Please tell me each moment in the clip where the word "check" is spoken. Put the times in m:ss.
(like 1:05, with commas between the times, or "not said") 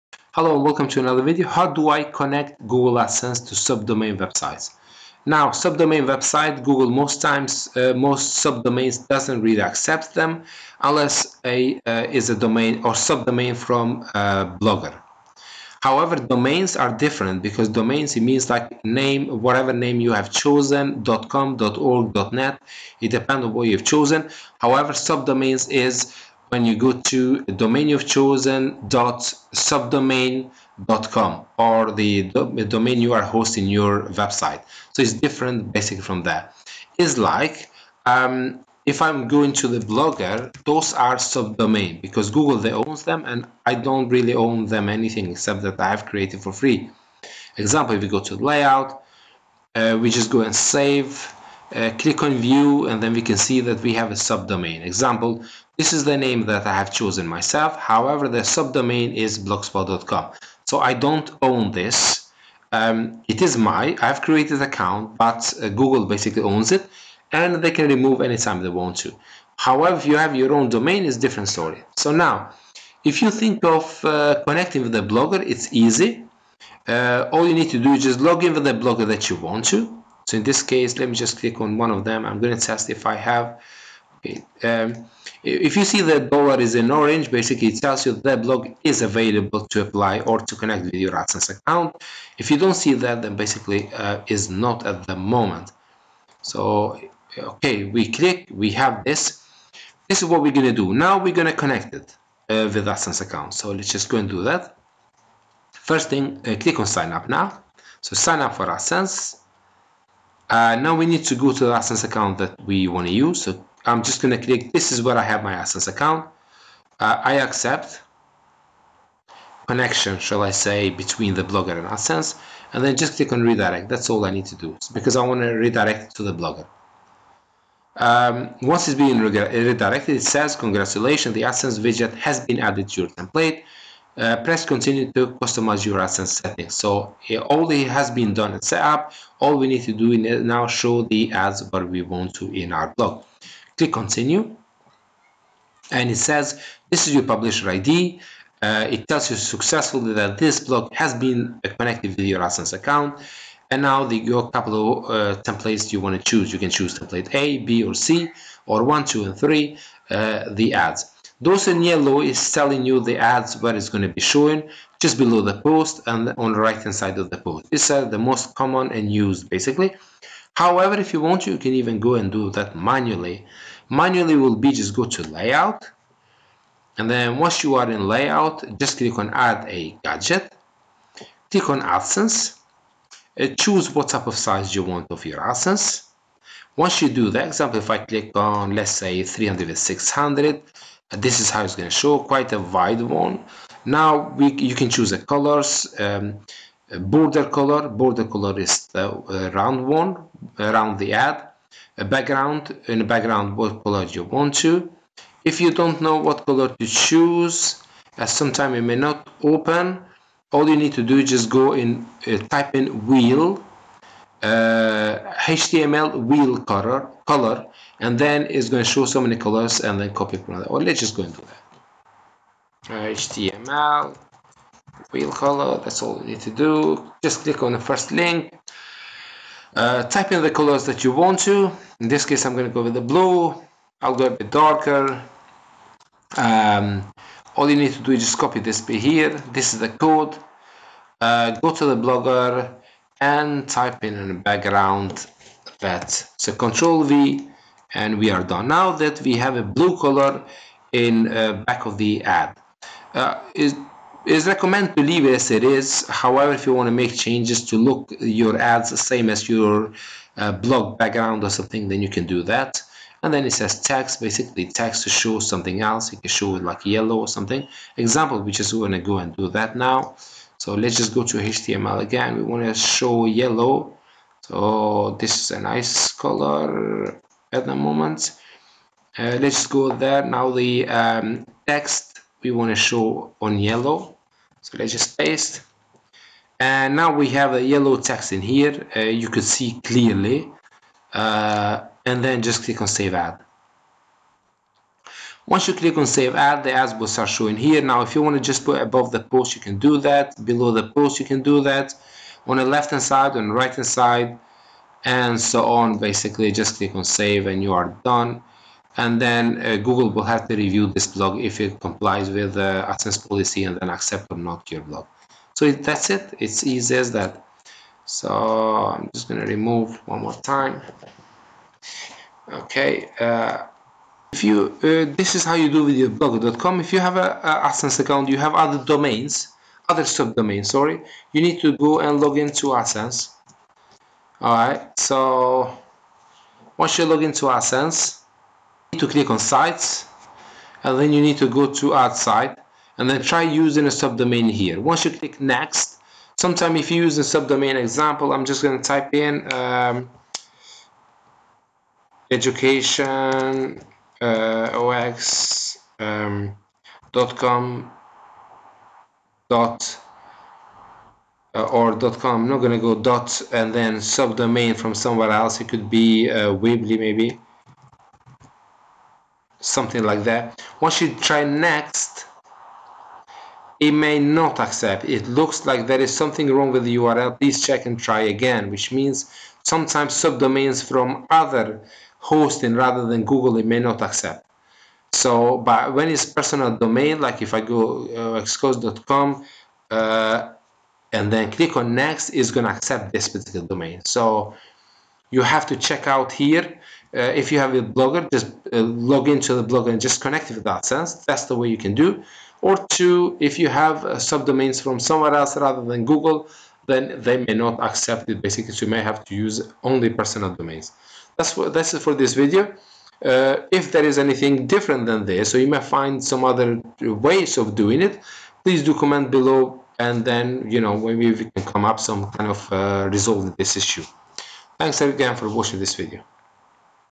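6:17, 6:35.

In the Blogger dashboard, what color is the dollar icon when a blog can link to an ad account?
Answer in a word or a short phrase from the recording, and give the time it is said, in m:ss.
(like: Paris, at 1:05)
orange, at 1:26.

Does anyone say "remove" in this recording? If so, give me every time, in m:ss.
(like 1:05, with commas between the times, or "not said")
1:07, 5:19.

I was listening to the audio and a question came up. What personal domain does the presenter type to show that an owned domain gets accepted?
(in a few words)
xcos.com.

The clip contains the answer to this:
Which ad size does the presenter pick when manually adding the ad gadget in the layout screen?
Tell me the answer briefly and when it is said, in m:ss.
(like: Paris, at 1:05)
300 600, at 3:09.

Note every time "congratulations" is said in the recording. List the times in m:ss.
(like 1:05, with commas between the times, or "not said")
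2:10.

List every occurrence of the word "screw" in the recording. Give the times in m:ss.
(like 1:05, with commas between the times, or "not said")
not said.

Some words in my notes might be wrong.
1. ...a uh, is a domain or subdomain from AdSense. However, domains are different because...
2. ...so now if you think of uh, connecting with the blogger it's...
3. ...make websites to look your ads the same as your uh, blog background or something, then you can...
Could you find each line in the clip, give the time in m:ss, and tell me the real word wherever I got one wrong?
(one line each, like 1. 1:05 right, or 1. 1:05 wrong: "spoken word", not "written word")
1. 0:11 wrong: "Blogger", not "AdSense"
2. 1:11 right
3. 4:16 wrong: "changes", not "websites".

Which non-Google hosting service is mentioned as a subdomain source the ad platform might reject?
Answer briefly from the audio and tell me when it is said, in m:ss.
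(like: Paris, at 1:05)
Weebly, at 6:06.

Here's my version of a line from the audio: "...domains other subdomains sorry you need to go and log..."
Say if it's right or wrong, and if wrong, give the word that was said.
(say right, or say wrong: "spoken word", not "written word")
right.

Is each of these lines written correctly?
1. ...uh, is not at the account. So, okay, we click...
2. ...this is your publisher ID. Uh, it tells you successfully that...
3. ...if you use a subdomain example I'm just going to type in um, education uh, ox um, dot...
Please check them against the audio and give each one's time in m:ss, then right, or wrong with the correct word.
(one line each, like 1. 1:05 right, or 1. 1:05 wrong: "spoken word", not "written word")
1. 1:33 wrong: "moment", not "account"
2. 2:26 right
3. 5:46 right.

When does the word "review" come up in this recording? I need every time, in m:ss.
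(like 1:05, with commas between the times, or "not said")
5:10.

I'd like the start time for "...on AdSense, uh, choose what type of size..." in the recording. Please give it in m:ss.
3:01.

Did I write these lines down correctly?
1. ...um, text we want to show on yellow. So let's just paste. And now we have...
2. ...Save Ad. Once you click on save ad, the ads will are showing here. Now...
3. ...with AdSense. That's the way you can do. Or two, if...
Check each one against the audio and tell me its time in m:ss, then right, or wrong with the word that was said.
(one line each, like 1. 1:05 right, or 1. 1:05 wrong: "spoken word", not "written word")
1. 4:40 right
2. 4:52 right
3. 6:40 right.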